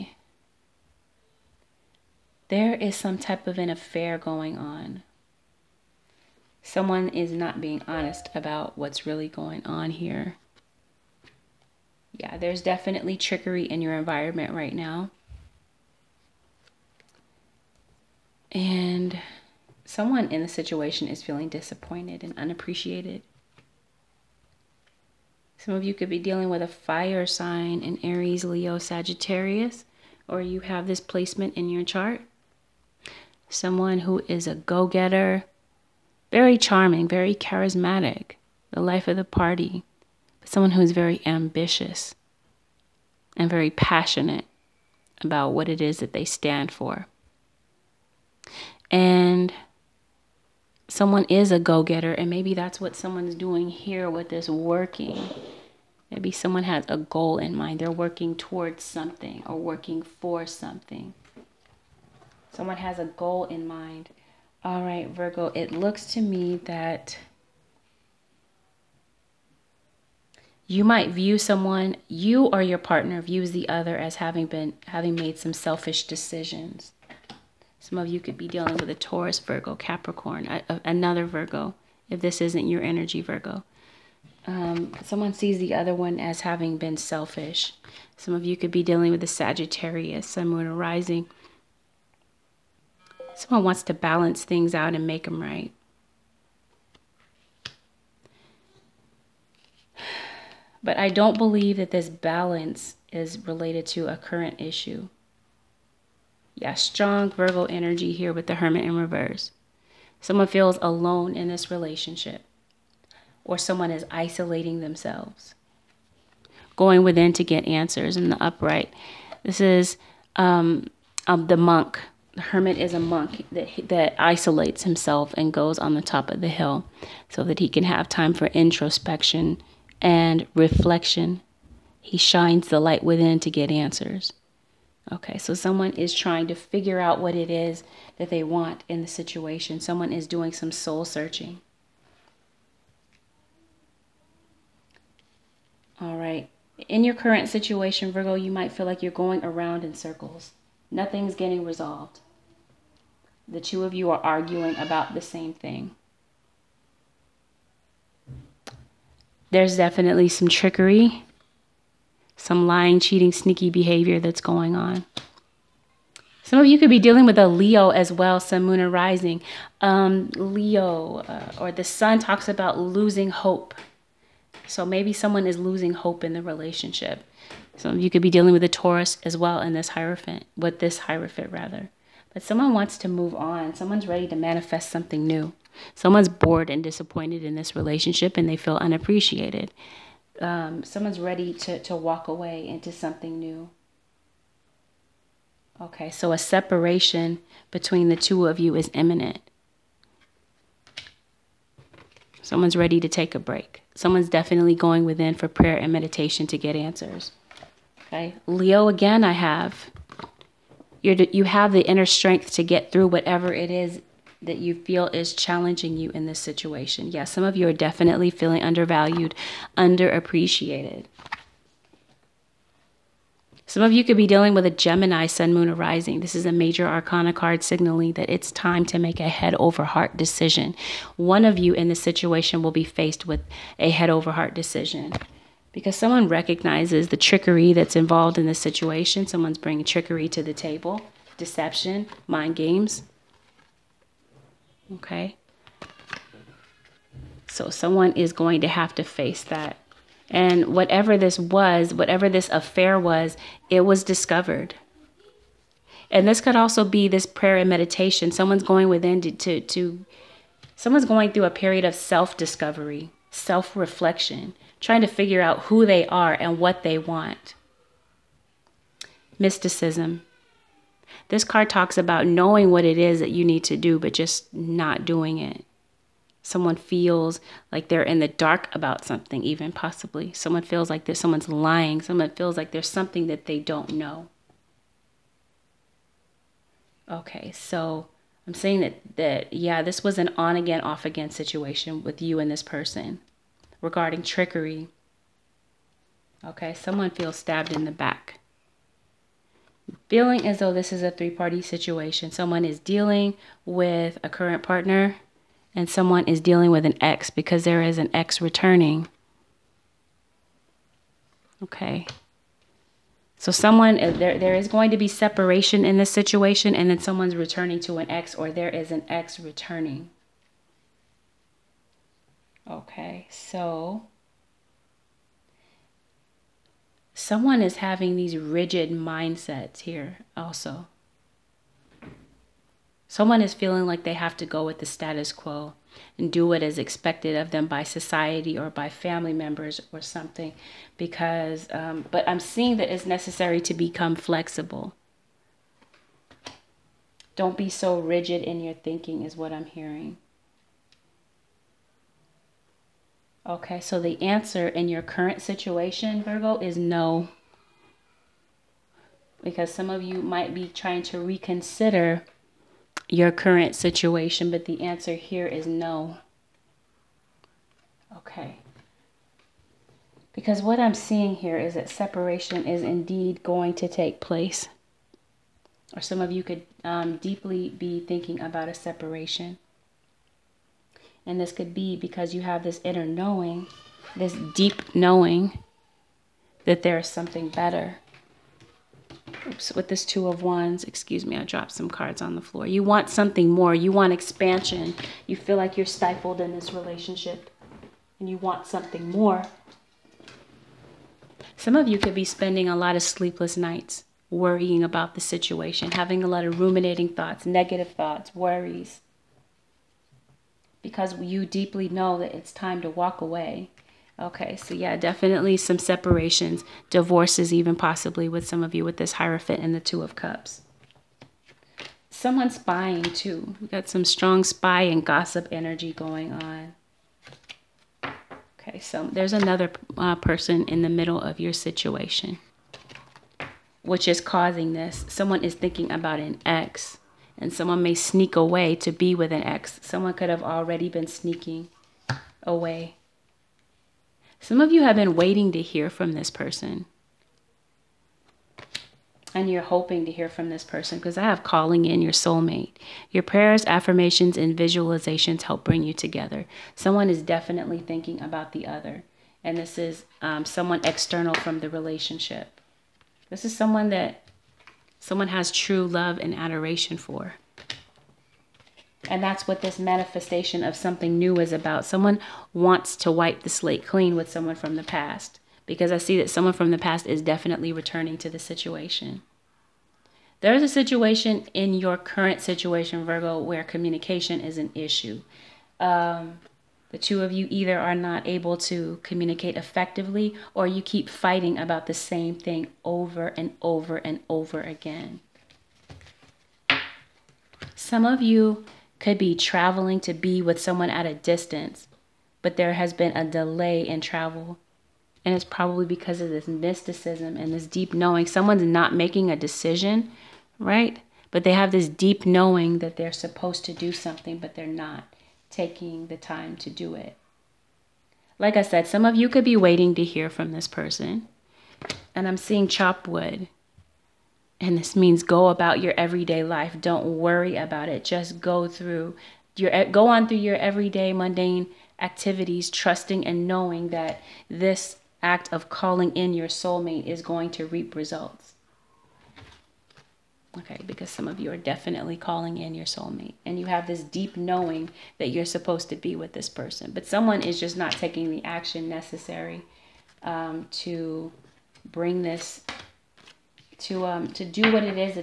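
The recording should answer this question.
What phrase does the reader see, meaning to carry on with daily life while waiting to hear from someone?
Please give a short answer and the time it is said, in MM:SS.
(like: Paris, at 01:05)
chop wood, at 08:42.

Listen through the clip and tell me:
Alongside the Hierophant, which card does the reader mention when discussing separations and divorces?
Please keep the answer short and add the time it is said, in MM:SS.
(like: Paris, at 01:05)
Two of Cups, at 06:59.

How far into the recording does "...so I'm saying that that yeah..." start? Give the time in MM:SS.
04:47.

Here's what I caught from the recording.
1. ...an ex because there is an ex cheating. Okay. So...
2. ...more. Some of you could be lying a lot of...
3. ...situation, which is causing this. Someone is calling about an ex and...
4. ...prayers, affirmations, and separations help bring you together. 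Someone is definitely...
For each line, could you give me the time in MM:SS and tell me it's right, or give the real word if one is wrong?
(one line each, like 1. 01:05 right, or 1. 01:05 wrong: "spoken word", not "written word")
1. 05:06 wrong: "returning", not "cheating"
2. 06:39 wrong: "spending", not "lying"
3. 07:11 wrong: "thinking", not "calling"
4. 07:33 wrong: "visualizations", not "separations".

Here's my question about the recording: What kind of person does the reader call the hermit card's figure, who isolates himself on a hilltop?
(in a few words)
a monk.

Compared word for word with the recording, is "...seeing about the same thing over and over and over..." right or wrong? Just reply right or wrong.
wrong.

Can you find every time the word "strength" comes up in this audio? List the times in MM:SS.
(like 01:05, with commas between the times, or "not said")
03:32.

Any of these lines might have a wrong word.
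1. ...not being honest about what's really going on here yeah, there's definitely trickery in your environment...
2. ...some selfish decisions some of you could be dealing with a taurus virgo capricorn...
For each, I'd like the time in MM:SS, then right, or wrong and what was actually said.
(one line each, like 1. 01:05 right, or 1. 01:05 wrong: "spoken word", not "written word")
1. 00:07 right
2. 01:15 right.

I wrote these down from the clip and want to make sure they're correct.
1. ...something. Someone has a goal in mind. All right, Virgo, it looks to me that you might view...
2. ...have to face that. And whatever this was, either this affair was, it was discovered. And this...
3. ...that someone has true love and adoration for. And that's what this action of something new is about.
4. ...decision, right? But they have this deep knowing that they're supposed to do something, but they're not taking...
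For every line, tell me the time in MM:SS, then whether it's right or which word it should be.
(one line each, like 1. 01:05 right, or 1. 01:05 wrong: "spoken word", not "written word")
1. 01:00 right
2. 04:08 wrong: "whatever", not "either"
3. 07:43 wrong: "manifestation", not "action"
4. 08:29 right.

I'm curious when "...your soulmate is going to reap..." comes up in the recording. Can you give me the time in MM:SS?
08:56.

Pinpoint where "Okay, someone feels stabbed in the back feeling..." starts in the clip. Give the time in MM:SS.
04:56.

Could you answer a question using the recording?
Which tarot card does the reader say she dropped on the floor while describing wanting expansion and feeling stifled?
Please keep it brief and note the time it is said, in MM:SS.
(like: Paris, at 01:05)
Two of Wands, at 06:30.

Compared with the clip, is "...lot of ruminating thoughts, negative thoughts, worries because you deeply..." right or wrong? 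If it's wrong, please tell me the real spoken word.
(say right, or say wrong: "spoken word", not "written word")
right.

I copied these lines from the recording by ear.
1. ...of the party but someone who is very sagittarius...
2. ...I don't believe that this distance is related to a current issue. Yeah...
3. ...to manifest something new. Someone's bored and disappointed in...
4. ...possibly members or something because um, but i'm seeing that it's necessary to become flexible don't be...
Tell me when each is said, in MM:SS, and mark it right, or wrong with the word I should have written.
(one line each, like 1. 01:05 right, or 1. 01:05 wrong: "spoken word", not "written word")
1. 00:39 wrong: "ambitious", not "sagittarius"
2. 01:40 wrong: "balance", not "distance"
3. 03:04 right
4. 05:38 wrong: "family", not "possibly".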